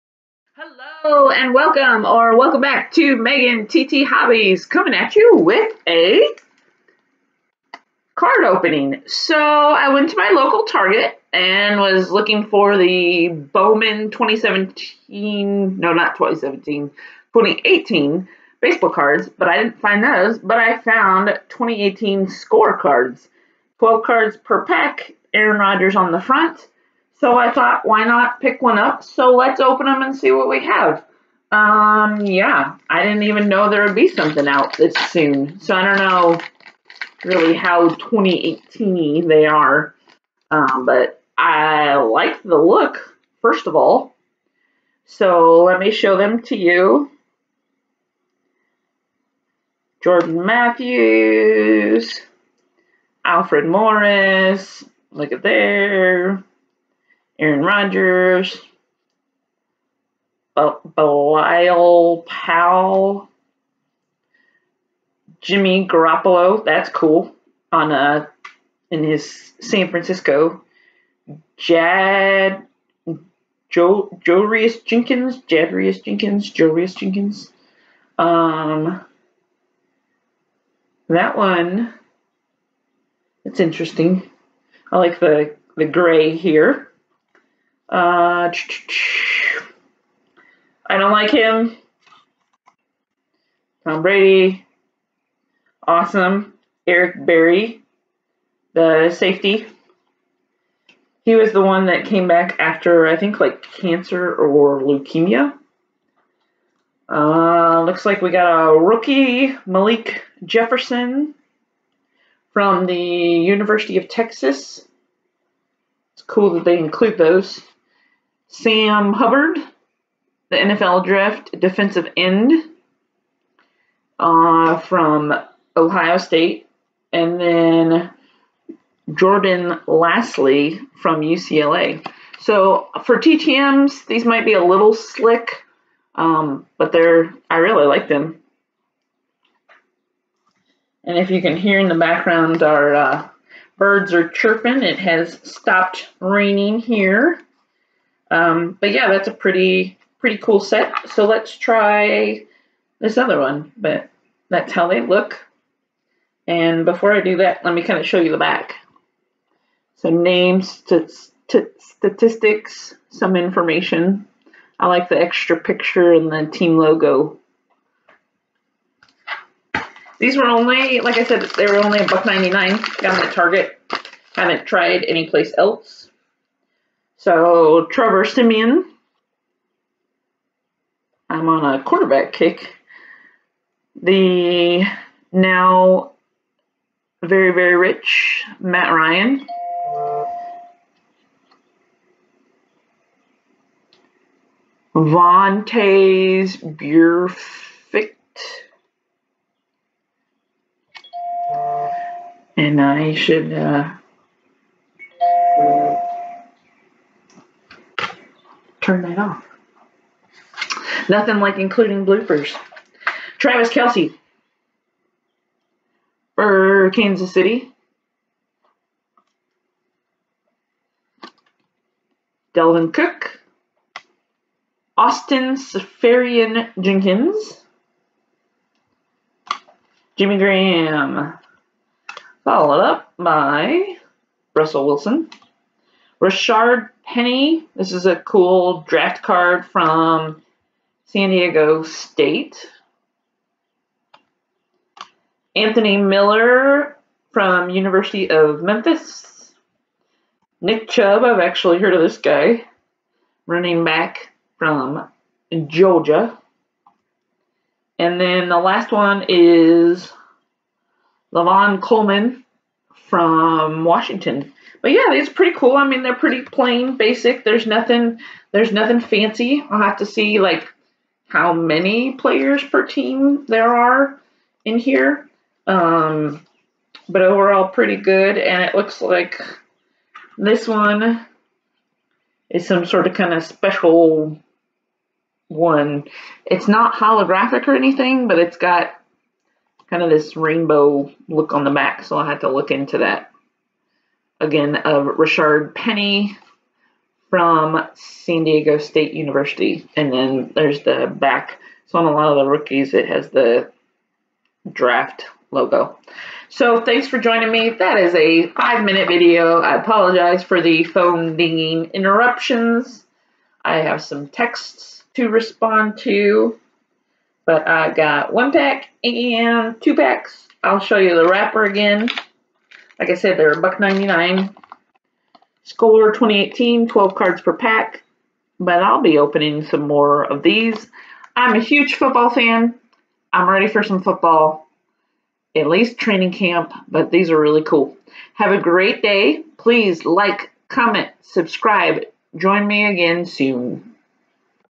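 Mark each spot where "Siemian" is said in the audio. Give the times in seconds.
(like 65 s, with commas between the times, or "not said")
178 s.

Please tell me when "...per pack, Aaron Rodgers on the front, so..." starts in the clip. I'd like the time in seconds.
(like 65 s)
24 s.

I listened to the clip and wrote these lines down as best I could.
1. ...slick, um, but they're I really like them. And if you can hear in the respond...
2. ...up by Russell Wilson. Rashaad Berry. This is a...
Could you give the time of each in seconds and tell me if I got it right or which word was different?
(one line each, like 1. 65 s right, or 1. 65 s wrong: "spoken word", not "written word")
1. 134 s wrong: "background", not "respond"
2. 232 s wrong: "Penny", not "Berry".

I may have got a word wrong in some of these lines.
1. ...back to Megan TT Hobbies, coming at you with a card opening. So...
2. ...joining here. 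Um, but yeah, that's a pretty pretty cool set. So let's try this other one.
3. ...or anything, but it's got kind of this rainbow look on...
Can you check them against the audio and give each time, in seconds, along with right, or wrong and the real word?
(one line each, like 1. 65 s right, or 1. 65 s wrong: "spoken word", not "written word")
1. 2 s right
2. 146 s wrong: "raining", not "joining"
3. 287 s right.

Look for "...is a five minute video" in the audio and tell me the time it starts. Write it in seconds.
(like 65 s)
307 s.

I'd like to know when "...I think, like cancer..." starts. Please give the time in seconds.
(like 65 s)
103 s.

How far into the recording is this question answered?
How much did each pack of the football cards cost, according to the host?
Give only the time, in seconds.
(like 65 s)
172 s.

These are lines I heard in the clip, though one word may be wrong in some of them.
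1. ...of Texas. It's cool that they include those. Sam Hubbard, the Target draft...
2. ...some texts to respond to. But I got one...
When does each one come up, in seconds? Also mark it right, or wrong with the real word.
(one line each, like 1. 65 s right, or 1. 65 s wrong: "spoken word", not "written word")
1. 113 s wrong: "NFL", not "Target"
2. 314 s right.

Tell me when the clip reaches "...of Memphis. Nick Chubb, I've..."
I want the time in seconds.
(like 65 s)
248 s.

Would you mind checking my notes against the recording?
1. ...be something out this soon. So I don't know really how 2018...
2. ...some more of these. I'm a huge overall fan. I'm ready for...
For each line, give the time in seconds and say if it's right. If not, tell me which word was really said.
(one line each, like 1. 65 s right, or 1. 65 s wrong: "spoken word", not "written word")
1. 33 s right
2. 329 s wrong: "football", not "overall".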